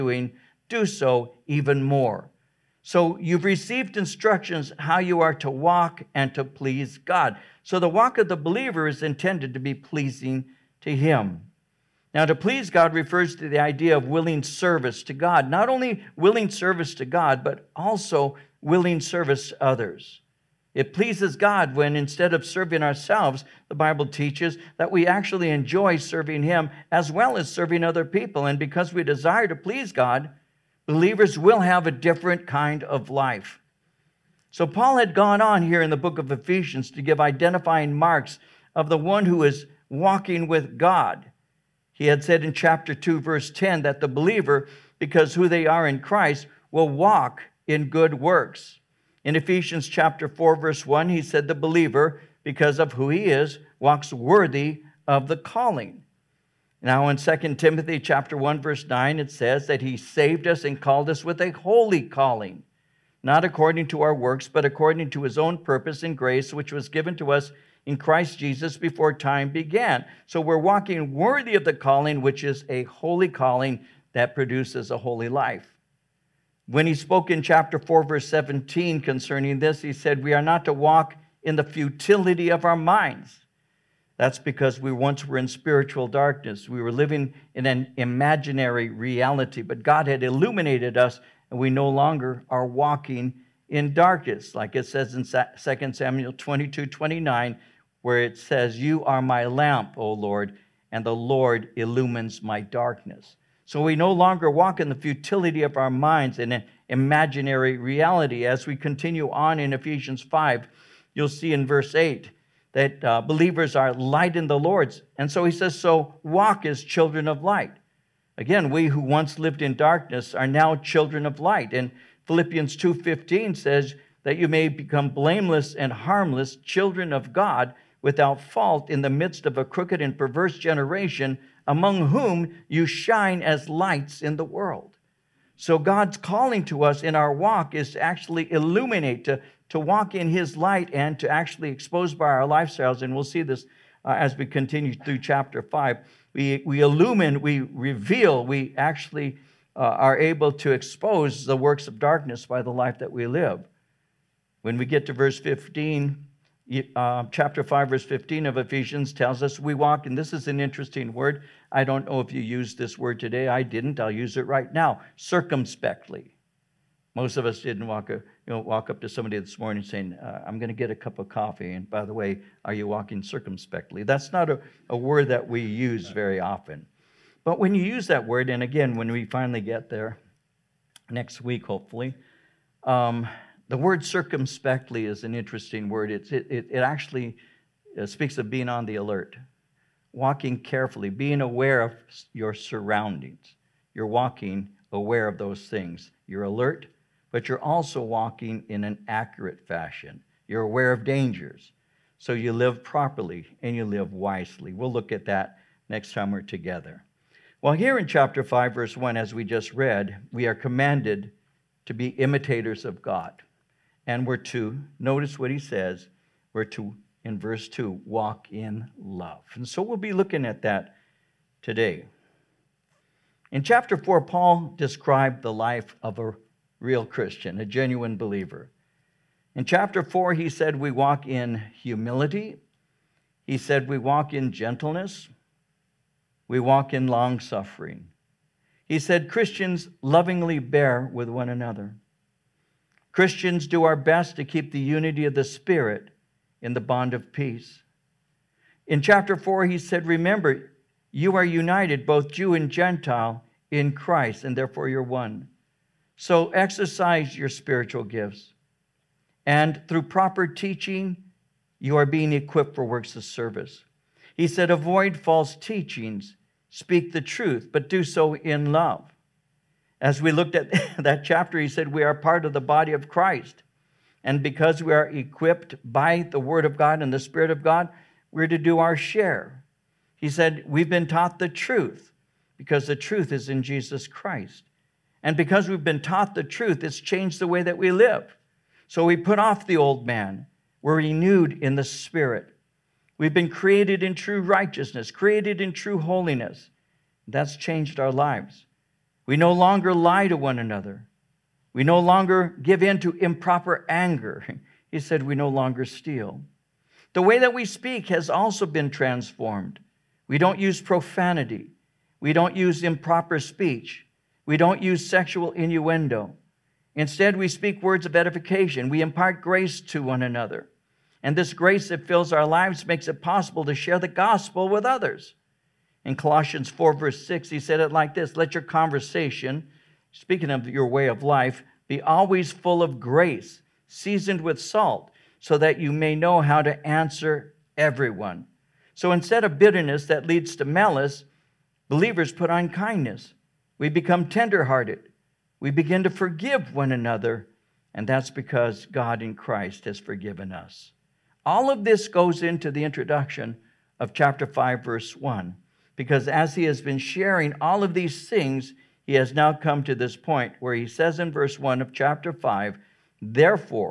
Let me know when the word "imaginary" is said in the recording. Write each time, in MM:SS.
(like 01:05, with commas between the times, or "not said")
01:27, 01:46.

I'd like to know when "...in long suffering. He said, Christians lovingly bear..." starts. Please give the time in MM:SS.
03:56.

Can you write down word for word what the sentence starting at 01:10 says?
So we're walking worthy of the calling, which is a holy calling that produces a holy life.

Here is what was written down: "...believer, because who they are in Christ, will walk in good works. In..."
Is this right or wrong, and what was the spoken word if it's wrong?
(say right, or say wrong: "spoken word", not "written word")
right.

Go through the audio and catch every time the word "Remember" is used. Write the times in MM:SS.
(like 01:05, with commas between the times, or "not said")
04:10.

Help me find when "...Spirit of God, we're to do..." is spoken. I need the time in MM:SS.
04:37.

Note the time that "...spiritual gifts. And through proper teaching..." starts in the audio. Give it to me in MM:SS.
04:17.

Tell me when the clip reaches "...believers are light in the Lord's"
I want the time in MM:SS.
01:53.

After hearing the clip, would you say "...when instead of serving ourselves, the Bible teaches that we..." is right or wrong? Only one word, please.
right.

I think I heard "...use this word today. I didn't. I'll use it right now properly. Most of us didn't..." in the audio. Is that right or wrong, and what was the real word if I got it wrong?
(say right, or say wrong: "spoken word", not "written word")
wrong: "circumspectly", not "properly".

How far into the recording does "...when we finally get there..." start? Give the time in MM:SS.
02:58.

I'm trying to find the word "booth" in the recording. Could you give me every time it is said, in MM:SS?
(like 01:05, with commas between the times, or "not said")
not said.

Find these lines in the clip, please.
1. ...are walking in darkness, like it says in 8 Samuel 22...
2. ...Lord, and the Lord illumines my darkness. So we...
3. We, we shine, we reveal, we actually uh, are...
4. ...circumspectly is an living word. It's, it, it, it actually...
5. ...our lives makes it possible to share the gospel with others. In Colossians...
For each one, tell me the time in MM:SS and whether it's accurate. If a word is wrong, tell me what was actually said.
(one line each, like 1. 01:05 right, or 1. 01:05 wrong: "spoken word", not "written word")
1. 01:32 wrong: "2", not "8"
2. 01:40 right
3. 02:26 wrong: "illumine", not "shine"
4. 03:04 wrong: "interesting", not "living"
5. 05:22 right.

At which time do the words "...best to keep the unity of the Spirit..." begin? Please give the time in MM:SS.
04:03.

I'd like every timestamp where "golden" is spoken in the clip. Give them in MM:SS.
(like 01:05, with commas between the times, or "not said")
not said.